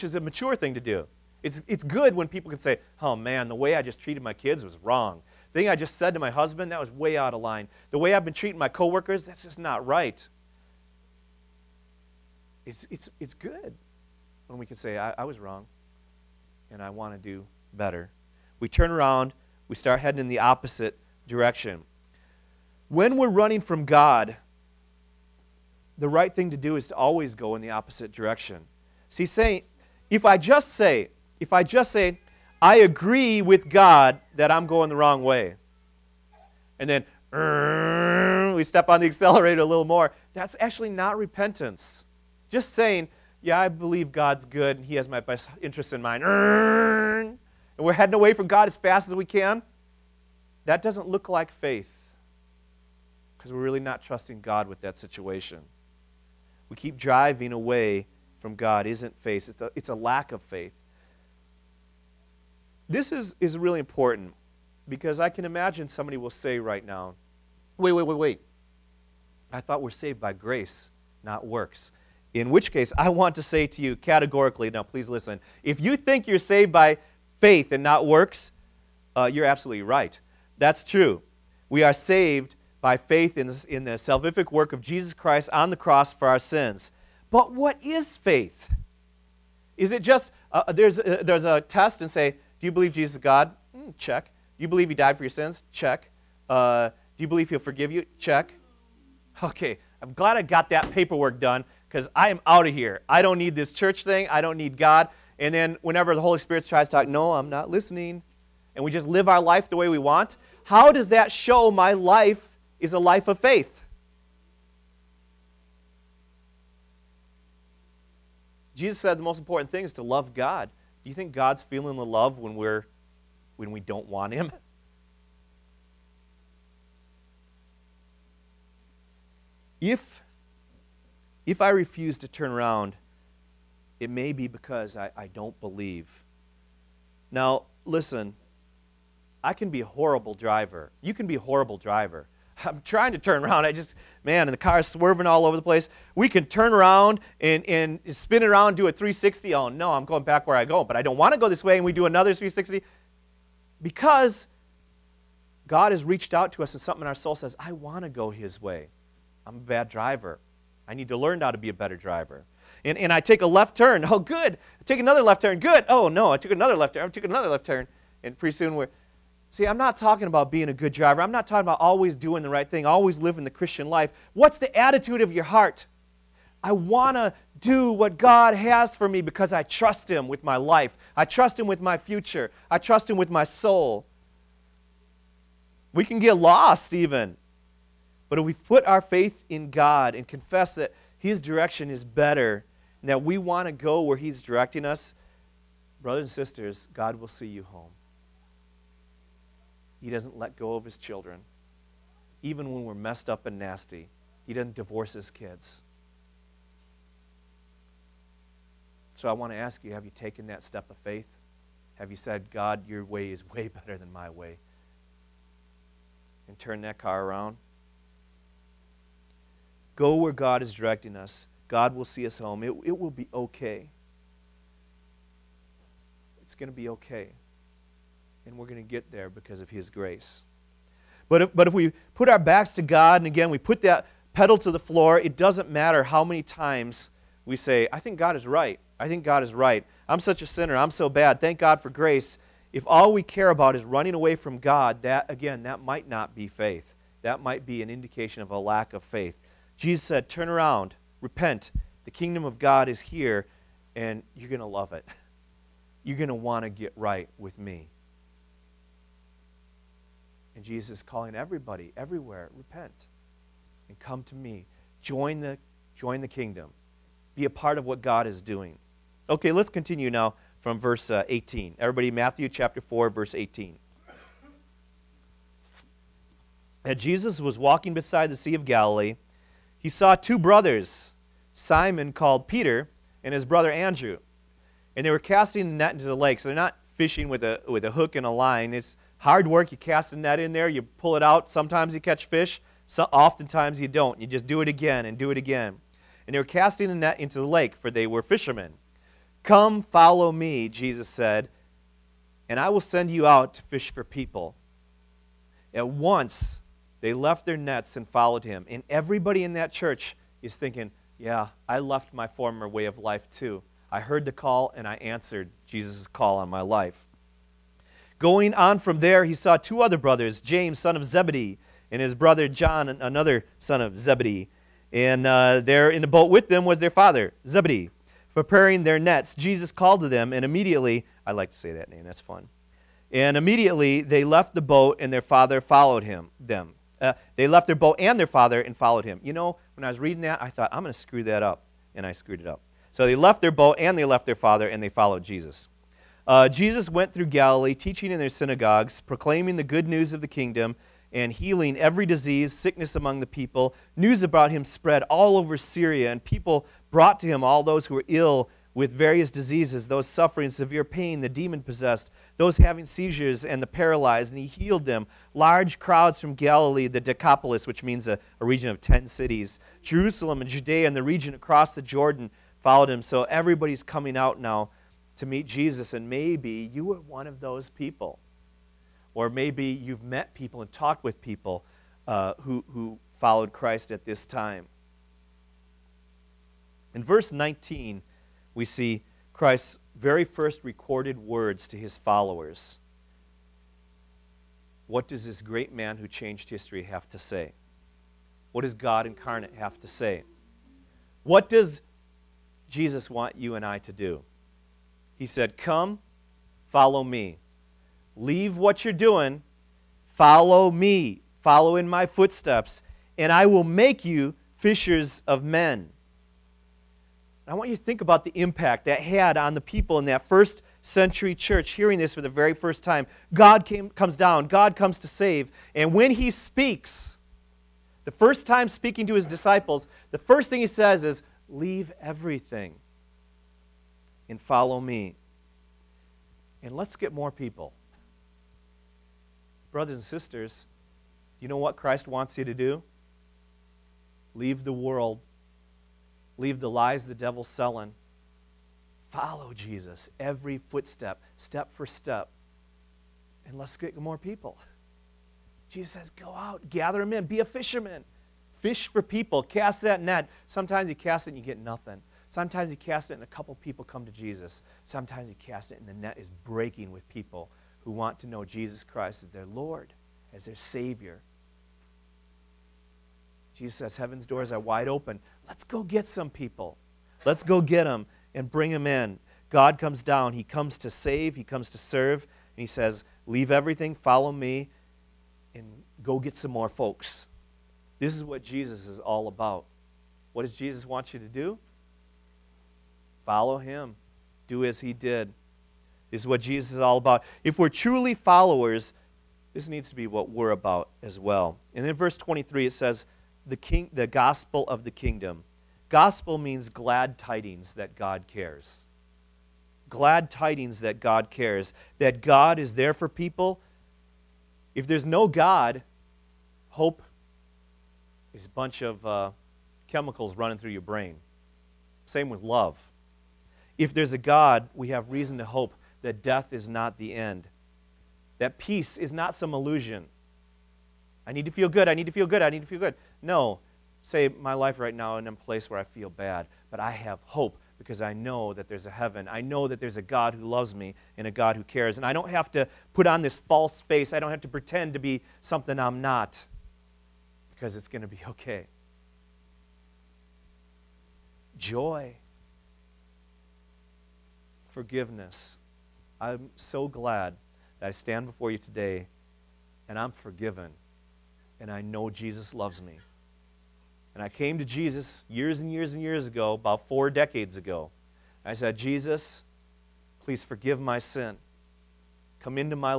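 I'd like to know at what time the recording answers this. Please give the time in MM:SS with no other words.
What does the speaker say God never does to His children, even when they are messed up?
03:24.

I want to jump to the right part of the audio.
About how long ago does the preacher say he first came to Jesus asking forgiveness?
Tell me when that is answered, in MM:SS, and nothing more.
09:26.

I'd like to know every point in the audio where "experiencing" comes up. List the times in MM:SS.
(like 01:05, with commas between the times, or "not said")
not said.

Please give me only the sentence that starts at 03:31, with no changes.
Have you said, God, your way is way better than my way?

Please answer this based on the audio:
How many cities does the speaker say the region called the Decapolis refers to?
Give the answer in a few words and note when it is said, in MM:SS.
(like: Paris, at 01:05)
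10, at 06:08.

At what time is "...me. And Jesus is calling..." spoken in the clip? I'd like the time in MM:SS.
04:17.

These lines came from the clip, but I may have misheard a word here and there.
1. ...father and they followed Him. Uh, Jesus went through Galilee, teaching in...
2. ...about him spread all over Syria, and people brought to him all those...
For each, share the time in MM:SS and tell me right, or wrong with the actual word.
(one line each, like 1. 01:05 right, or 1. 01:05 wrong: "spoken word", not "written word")
1. 05:44 wrong: "Jesus", not "Him"
2. 05:54 right.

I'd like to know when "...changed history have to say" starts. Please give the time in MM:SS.
06:36.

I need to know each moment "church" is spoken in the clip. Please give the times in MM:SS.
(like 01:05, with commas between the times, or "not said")
01:43, 05:09, 07:01.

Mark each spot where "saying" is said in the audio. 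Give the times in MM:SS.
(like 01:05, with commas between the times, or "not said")
00:29, 00:42.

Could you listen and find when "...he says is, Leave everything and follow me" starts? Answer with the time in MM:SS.
07:10.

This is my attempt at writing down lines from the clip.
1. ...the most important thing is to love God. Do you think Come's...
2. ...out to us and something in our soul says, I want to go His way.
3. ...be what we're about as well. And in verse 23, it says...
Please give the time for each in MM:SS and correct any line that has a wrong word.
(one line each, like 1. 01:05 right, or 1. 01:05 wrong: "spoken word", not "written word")
1. 01:59 wrong: "God", not "Come"
2. 02:36 right
3. 08:19 right.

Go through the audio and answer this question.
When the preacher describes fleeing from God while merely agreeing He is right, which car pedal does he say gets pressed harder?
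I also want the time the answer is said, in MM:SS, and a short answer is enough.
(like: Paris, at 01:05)
accelerator, at 00:39.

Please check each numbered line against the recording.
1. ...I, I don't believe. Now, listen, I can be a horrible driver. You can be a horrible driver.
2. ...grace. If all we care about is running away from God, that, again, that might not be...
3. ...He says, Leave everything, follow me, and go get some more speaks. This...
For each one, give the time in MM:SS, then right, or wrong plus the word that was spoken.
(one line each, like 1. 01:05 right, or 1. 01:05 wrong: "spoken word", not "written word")
1. 02:14 right
2. 04:01 right
3. 08:02 wrong: "folks", not "speaks".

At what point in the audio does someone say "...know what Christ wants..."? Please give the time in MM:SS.
07:21.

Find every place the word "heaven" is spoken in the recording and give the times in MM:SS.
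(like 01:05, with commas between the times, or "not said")
07:53, 08:58.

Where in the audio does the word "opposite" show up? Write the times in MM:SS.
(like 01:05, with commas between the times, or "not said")
00:20, 00:27.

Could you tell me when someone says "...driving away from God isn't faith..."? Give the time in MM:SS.
00:56.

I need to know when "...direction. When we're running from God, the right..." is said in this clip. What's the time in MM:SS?
00:21.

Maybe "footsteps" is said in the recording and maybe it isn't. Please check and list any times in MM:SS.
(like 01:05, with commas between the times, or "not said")
06:52, 07:30.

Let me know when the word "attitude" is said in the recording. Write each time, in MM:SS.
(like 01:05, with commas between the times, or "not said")
02:54.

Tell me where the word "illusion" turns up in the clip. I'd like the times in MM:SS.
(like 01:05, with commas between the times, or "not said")
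08:49.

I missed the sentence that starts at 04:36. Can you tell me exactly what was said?
And Jesus was walking beside the Sea of Galilee he saw two brothers, Simon called Peter and his brother Andrew.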